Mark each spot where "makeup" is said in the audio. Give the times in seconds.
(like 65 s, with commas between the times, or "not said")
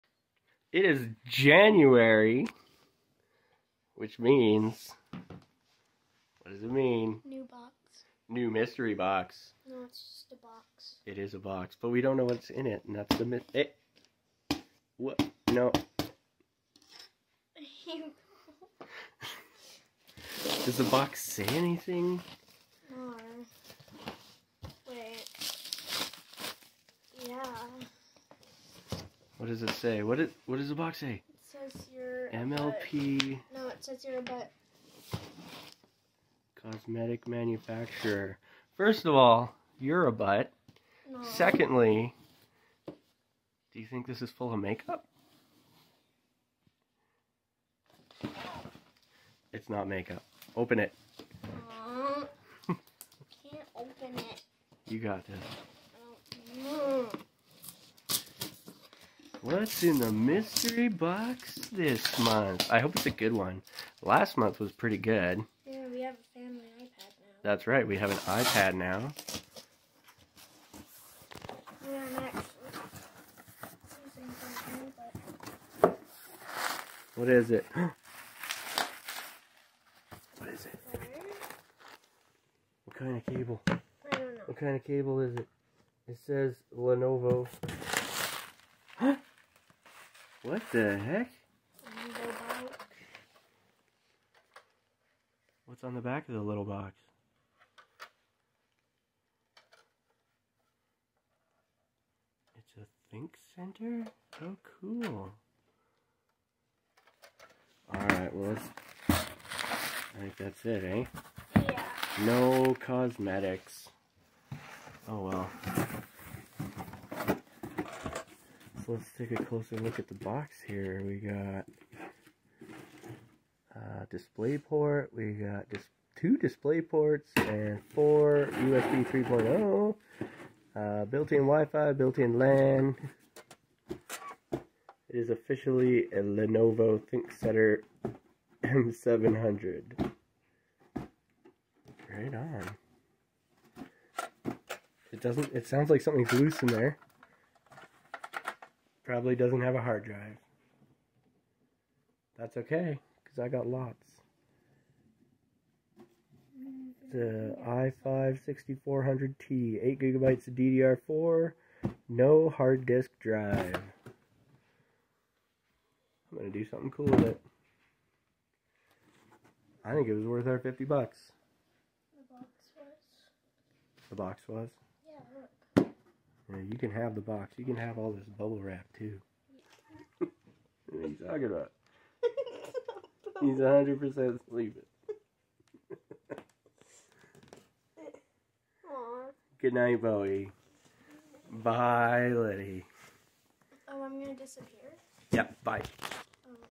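44 s, 49 s.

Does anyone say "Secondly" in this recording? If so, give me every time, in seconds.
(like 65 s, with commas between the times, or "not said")
41 s.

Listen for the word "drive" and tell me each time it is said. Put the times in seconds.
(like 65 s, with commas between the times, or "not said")
150 s, 163 s.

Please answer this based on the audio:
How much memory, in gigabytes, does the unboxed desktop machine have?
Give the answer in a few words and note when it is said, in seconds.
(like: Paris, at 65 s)
8, at 159 s.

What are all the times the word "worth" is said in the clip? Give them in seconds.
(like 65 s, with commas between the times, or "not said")
170 s.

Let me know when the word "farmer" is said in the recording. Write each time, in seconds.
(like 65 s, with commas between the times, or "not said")
not said.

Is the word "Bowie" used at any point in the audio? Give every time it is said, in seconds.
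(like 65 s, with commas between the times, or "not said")
190 s.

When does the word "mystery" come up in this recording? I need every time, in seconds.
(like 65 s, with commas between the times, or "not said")
8 s, 60 s.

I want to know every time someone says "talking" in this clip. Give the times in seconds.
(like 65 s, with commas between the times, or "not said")
181 s.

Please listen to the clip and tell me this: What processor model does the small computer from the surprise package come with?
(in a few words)
i5-6400T.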